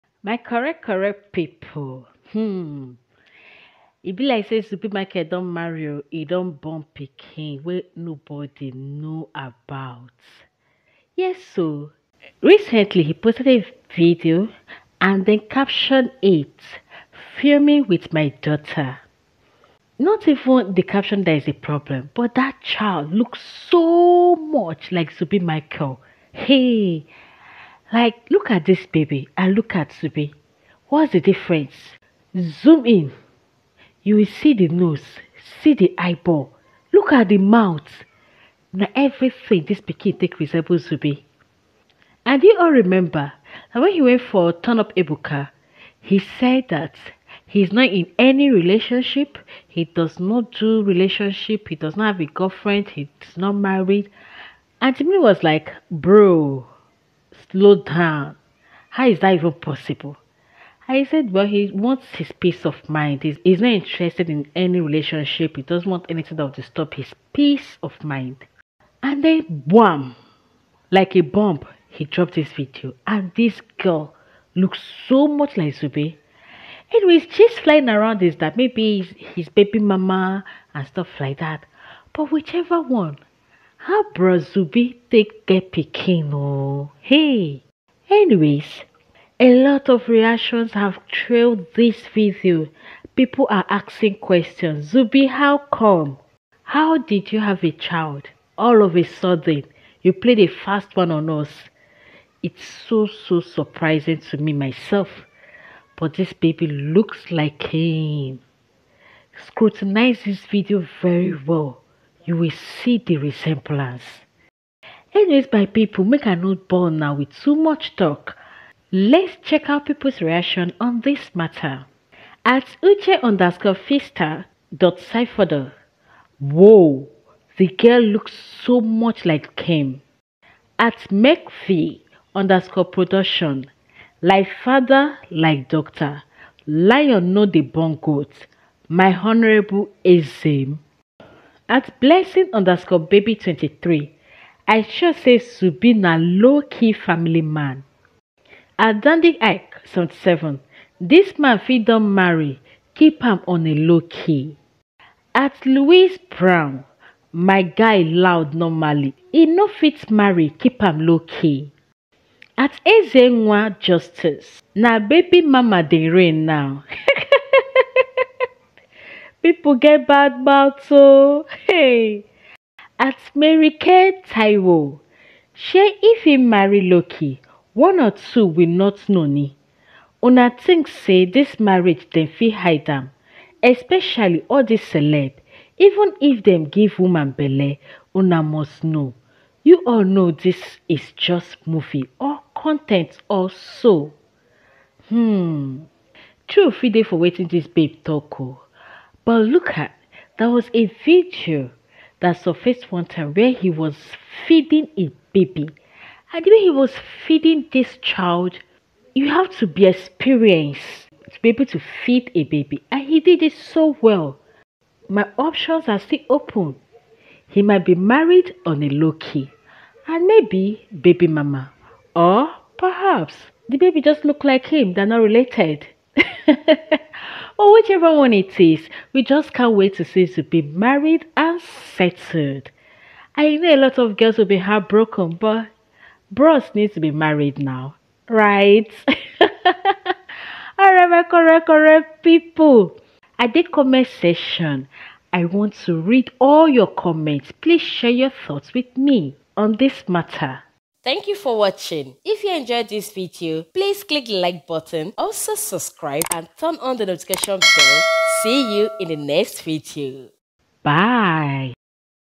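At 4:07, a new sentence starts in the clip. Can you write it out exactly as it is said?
Please share your thoughts with me on this matter.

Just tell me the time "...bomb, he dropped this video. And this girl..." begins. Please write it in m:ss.
1:11.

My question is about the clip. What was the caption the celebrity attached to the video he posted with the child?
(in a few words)
Filming with my daughter.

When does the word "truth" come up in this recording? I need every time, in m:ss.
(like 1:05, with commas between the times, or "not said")
3:16.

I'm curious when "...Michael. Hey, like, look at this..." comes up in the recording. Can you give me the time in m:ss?
0:25.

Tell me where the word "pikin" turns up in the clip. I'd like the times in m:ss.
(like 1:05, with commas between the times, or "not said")
0:06, 0:39.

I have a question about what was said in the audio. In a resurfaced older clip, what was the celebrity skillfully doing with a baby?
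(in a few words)
Feeding a baby.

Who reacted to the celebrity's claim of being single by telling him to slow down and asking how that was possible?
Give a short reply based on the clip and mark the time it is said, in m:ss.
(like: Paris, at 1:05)
Jimmy, at 0:54.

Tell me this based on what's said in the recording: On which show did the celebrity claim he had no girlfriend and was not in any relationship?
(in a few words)
Turn Up Ebuka.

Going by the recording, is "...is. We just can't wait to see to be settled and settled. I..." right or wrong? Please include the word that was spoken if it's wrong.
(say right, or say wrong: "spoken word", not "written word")
wrong: "married", not "settled".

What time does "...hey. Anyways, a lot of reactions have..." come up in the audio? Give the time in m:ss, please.
1:27.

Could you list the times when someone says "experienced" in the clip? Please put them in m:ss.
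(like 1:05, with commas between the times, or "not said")
3:29.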